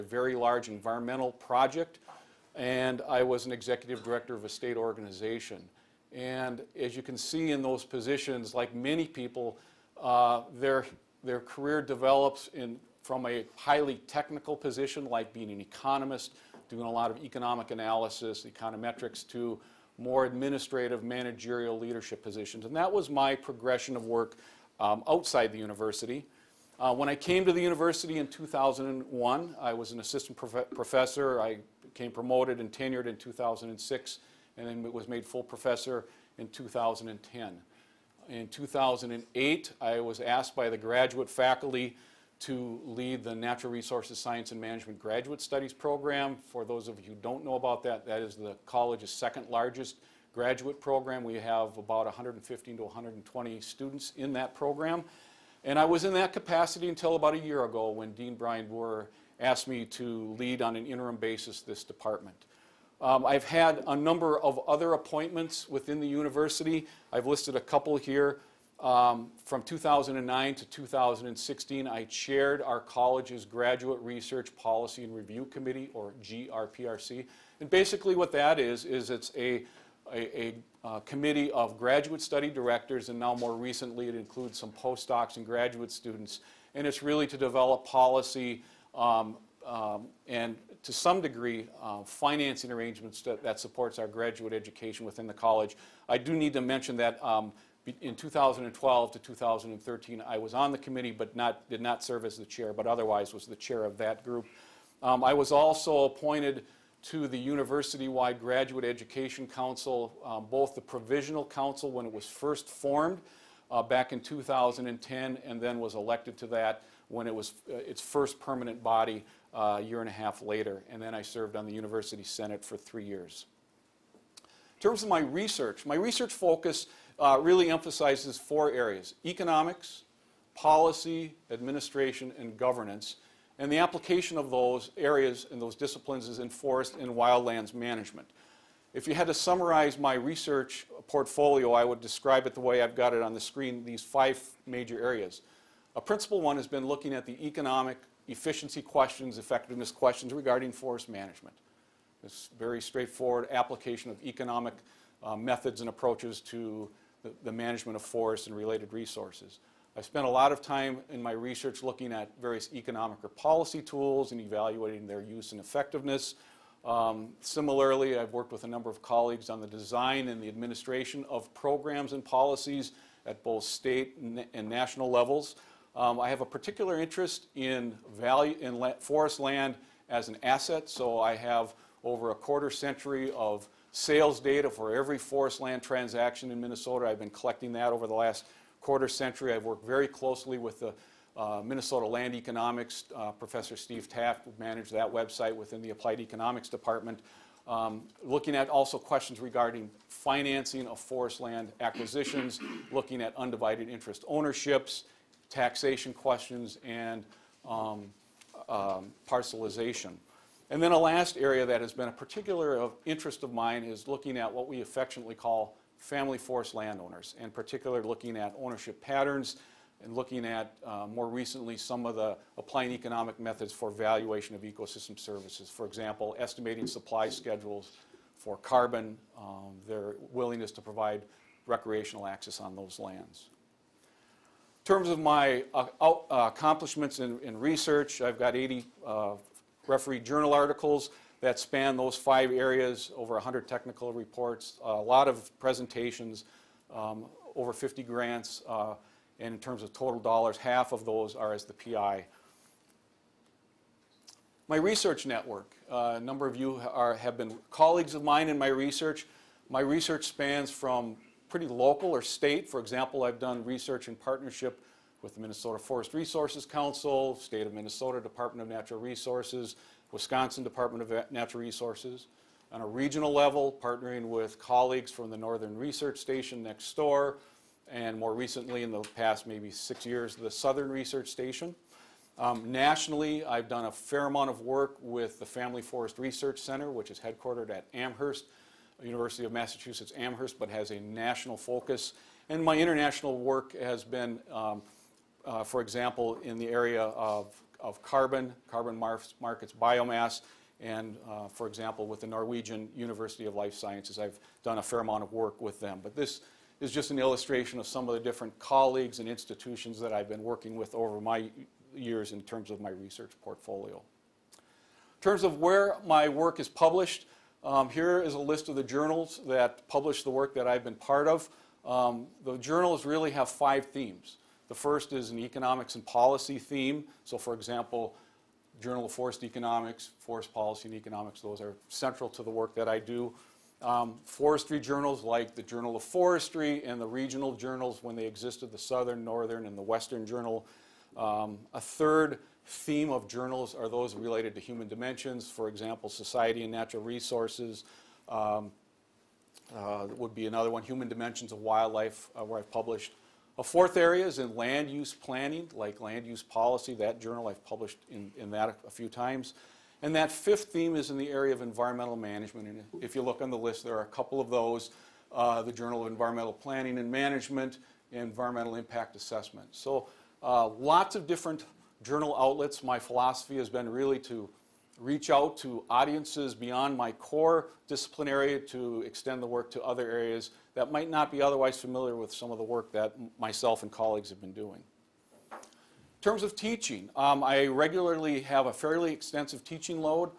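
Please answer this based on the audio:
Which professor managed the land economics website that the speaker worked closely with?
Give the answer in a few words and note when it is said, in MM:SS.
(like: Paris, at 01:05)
Steve Taff, at 03:13.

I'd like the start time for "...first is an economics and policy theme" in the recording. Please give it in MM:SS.
05:24.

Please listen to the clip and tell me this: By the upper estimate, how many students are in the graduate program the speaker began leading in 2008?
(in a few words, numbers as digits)
120.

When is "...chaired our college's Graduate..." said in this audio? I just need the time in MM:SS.
01:12.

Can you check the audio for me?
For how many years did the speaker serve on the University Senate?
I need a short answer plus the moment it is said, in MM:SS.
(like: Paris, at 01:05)
3, at 02:02.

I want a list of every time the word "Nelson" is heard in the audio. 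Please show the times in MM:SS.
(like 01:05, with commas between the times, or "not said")
not said.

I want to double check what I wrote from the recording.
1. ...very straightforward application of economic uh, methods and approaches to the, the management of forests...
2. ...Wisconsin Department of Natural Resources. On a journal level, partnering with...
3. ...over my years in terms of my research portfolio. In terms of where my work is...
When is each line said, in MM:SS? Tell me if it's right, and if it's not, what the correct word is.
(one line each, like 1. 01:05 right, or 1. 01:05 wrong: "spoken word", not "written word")
1. 02:32 right
2. 04:30 wrong: "regional", not "journal"
3. 05:10 right.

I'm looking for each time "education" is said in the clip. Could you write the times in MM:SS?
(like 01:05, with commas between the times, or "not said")
01:34, 01:48.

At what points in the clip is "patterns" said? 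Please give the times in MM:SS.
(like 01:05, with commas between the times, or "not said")
03:39.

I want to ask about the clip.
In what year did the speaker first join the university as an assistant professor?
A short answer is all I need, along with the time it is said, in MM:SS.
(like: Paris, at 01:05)
2001, at 00:28.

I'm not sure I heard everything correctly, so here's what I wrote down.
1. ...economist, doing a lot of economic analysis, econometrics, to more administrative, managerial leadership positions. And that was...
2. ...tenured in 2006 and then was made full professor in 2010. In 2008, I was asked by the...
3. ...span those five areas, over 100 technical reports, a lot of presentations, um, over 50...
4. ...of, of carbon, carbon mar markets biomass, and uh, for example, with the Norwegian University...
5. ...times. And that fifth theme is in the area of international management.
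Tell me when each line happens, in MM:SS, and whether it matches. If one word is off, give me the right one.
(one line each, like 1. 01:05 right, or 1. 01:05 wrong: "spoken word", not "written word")
1. 00:15 right
2. 00:32 right
3. 04:01 right
4. 04:57 right
5. 05:59 wrong: "environmental", not "international".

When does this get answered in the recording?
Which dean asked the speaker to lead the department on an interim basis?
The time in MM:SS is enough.
00:58.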